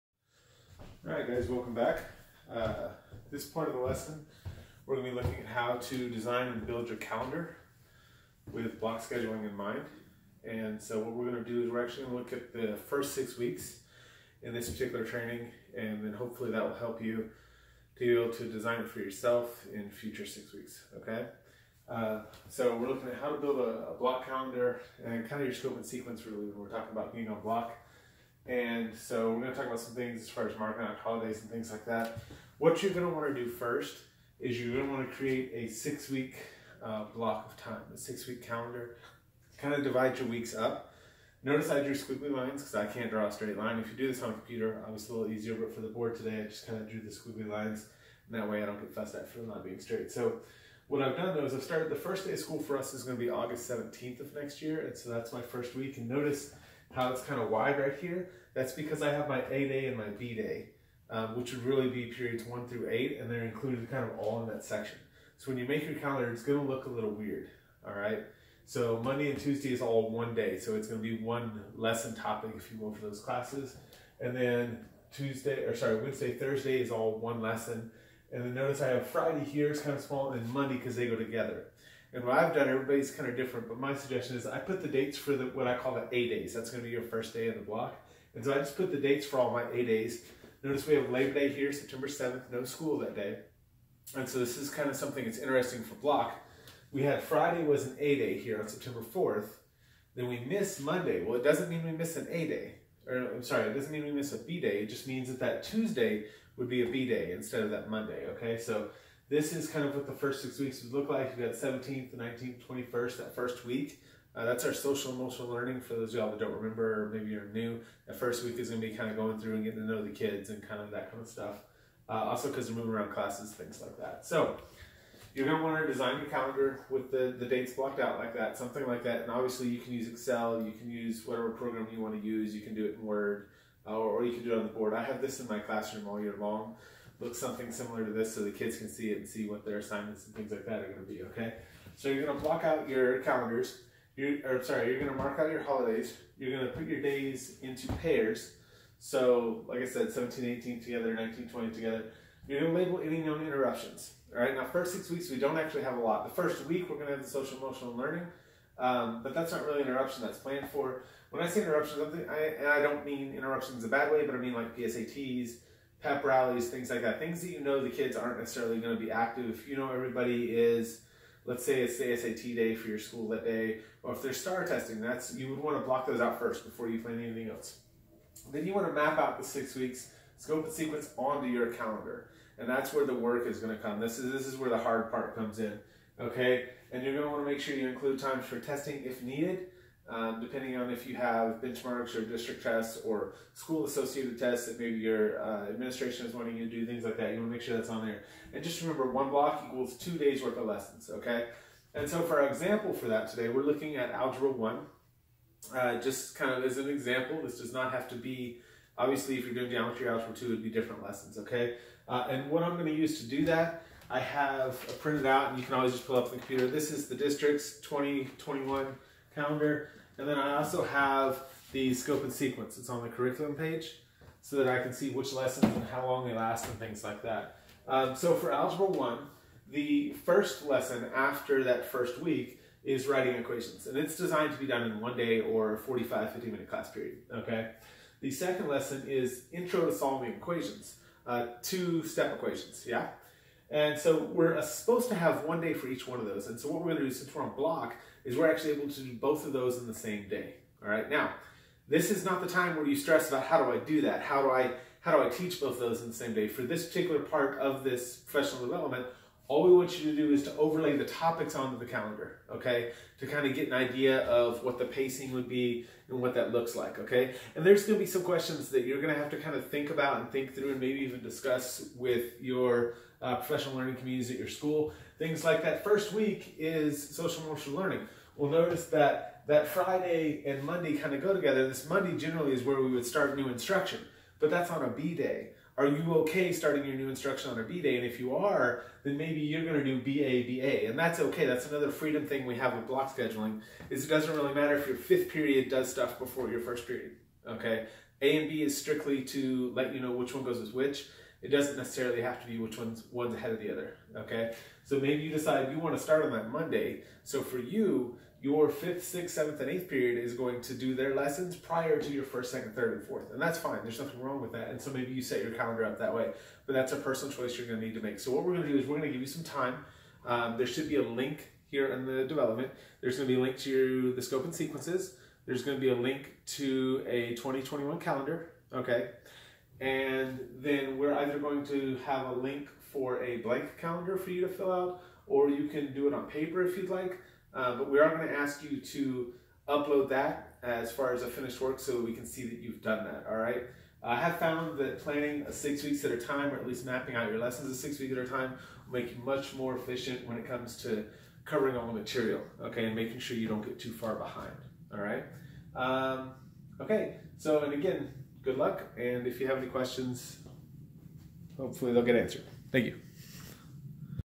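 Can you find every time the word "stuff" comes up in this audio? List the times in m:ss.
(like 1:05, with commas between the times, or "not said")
2:01, 4:55.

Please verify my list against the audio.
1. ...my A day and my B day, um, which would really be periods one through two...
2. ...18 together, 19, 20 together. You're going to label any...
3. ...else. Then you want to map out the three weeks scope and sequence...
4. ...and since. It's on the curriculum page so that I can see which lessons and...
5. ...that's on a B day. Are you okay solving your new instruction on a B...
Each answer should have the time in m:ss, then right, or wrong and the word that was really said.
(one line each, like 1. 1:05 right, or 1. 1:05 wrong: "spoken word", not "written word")
1. 0:59 wrong: "eight", not "two"
2. 2:30 right
3. 2:57 wrong: "six", not "three"
4. 3:42 wrong: "sequence", not "since"
5. 4:44 wrong: "starting", not "solving".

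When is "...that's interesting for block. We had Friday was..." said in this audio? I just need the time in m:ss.
1:35.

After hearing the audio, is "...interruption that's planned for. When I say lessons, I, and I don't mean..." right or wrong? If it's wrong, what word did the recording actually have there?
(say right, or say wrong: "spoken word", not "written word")
wrong: "interruptions", not "lessons".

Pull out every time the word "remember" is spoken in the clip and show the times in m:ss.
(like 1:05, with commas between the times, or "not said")
1:56, 3:18.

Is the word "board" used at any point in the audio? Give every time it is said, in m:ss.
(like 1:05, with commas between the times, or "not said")
0:45, 2:14.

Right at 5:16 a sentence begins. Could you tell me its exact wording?
But that's a personal choice you're going to need to make.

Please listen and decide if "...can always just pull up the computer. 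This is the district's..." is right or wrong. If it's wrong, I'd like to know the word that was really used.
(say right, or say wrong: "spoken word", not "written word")
right.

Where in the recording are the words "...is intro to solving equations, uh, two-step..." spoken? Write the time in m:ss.
3:59.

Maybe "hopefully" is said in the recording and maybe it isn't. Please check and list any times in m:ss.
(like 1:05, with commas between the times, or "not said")
0:16, 6:01.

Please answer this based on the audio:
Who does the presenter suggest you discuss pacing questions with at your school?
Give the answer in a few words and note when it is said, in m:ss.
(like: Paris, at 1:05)
Professional learning communities, at 4:33.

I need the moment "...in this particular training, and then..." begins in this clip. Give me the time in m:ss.
0:14.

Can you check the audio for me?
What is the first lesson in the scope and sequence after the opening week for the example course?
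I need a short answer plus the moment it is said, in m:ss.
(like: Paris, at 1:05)
Writing equations, at 3:53.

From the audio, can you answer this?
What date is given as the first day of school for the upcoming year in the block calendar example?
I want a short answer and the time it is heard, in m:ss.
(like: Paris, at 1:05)
August 17th, at 0:53.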